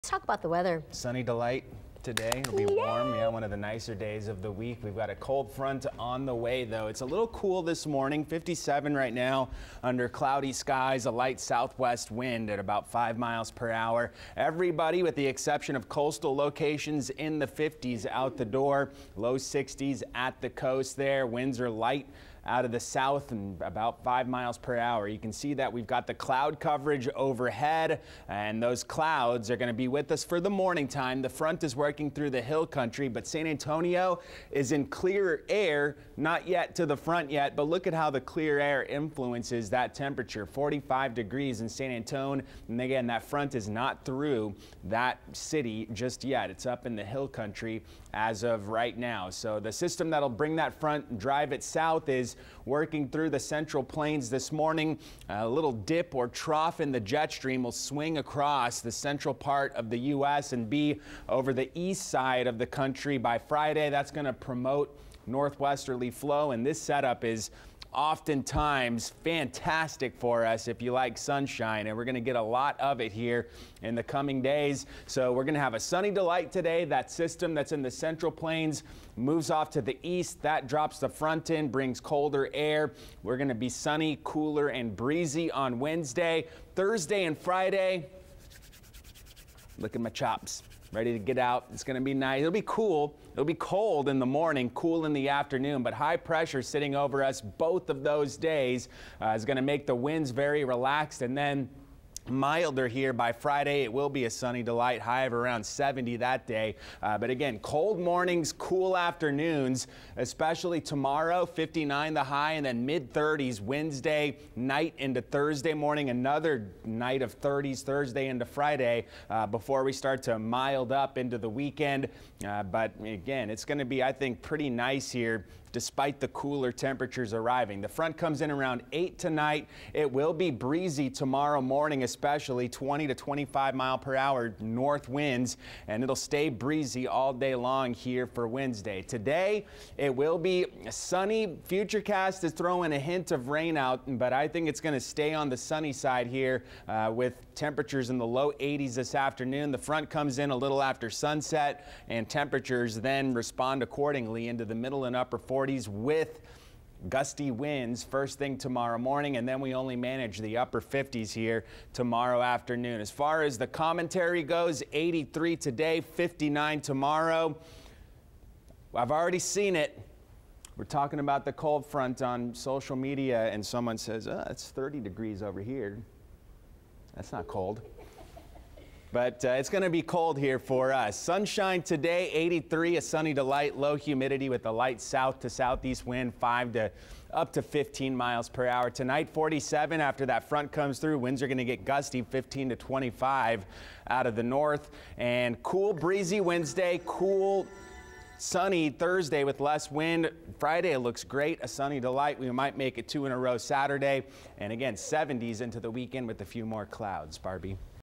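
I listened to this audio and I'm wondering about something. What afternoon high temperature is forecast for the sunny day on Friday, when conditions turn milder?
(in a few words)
70.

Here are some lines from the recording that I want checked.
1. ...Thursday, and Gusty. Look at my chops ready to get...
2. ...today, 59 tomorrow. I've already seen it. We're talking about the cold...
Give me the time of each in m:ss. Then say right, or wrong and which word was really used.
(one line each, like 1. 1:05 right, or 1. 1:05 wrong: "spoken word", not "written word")
1. 1:26 wrong: "Friday", not "Gusty"
2. 2:45 right.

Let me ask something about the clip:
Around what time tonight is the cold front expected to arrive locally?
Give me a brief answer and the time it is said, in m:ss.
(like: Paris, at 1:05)
8, at 2:08.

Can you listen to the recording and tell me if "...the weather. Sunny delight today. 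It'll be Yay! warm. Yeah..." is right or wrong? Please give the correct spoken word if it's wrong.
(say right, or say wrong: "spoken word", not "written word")
right.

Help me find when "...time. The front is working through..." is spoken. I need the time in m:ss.
0:30.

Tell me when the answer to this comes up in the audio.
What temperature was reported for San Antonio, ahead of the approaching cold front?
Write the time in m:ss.
0:40.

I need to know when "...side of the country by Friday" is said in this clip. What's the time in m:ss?
1:02.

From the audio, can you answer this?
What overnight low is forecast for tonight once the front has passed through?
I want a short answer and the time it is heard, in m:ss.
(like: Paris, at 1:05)
47, at 3:09.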